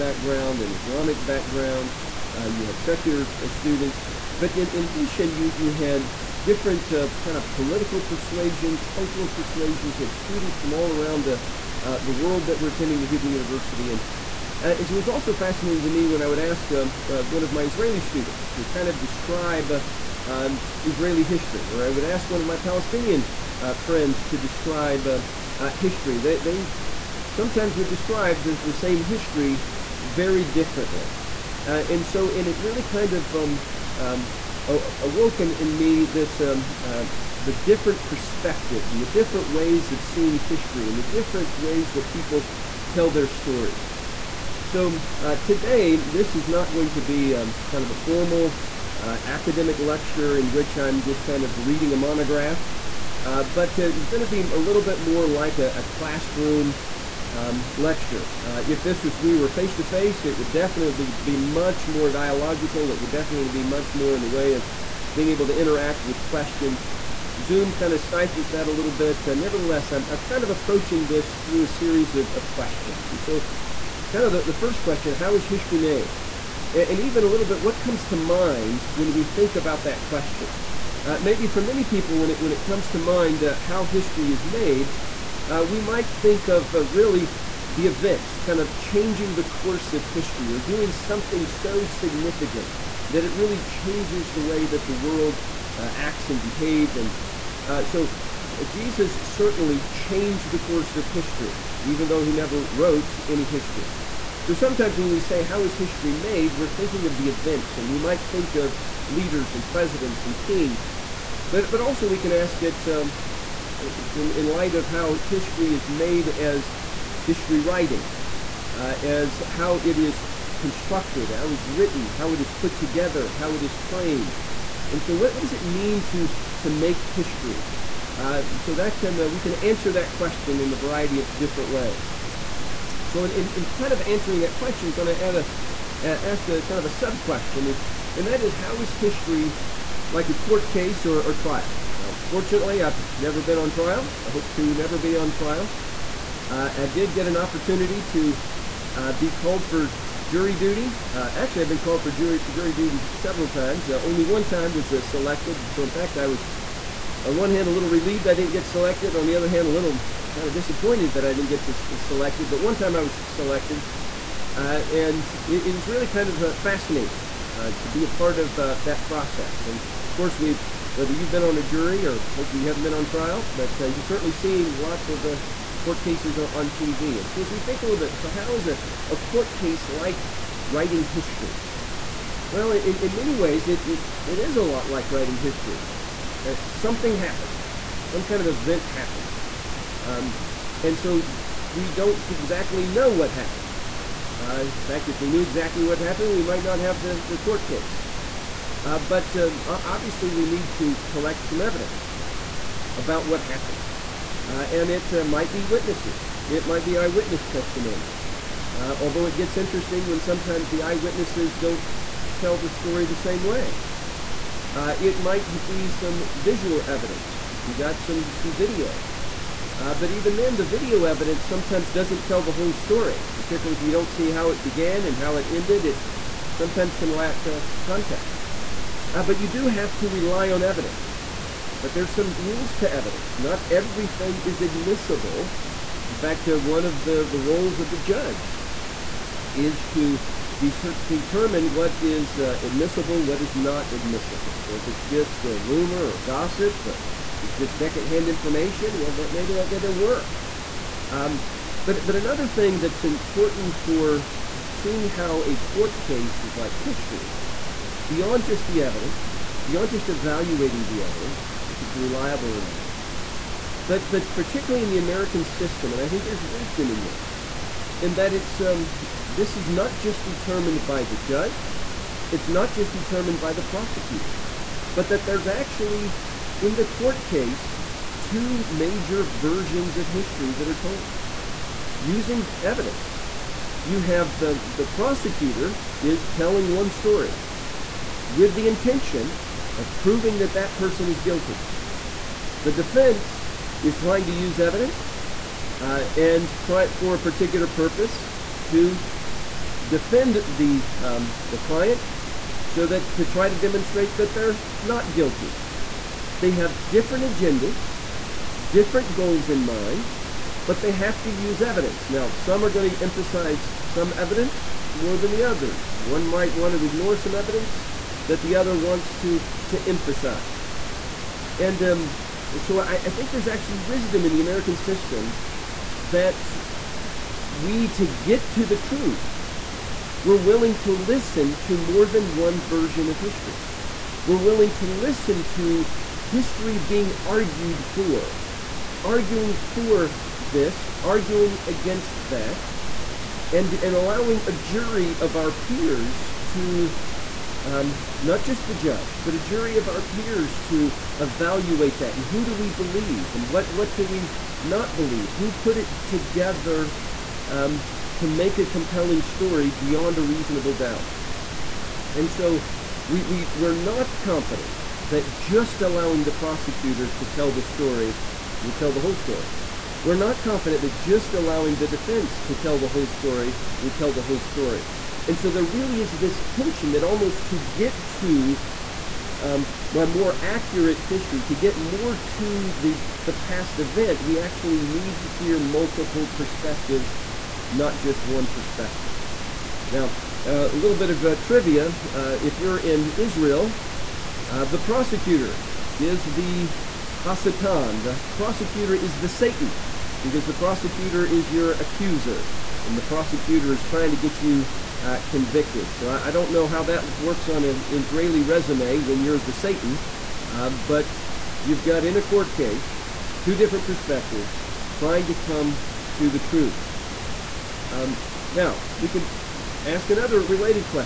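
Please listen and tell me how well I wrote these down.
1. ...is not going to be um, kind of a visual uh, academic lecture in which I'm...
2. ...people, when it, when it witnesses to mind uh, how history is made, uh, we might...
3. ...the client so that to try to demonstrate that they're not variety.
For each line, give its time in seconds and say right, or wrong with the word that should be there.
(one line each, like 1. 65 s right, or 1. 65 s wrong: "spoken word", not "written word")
1. 46 s wrong: "formal", not "visual"
2. 81 s wrong: "comes", not "witnesses"
3. 301 s wrong: "guilty", not "variety".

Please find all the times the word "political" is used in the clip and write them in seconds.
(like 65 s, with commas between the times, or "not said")
7 s.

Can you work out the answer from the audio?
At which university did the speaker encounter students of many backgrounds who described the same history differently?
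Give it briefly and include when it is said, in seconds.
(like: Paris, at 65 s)
Hebrew University, at 13 s.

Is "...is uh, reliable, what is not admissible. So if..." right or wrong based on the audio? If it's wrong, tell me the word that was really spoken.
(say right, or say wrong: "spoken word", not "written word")
wrong: "admissible", not "reliable".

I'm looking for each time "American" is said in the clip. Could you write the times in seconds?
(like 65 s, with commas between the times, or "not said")
264 s, 324 s.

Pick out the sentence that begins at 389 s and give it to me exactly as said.
Now, a little bit of uh, trivia.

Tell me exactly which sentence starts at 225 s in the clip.
It sometimes can lack uh, context.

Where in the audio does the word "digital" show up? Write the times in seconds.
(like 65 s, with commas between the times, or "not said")
not said.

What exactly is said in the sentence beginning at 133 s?
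So in, in, in kind of answering that question, I'm going to add a uh, ask a kind of a sub question.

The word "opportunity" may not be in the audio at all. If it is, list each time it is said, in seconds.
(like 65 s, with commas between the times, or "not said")
147 s.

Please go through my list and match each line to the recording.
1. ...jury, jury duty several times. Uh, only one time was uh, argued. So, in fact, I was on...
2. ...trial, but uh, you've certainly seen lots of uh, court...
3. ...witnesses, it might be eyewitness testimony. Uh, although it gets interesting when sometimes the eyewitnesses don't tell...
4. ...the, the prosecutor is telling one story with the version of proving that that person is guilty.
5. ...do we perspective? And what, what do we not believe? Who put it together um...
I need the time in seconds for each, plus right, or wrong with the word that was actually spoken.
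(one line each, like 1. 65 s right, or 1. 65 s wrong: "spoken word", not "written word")
1. 152 s wrong: "selected", not "argued"
2. 173 s right
3. 205 s right
4. 284 s wrong: "intention", not "version"
5. 352 s wrong: "believe", not "perspective".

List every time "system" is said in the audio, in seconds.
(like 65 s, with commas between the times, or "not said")
265 s, 324 s.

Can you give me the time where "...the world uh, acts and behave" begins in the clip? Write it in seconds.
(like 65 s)
94 s.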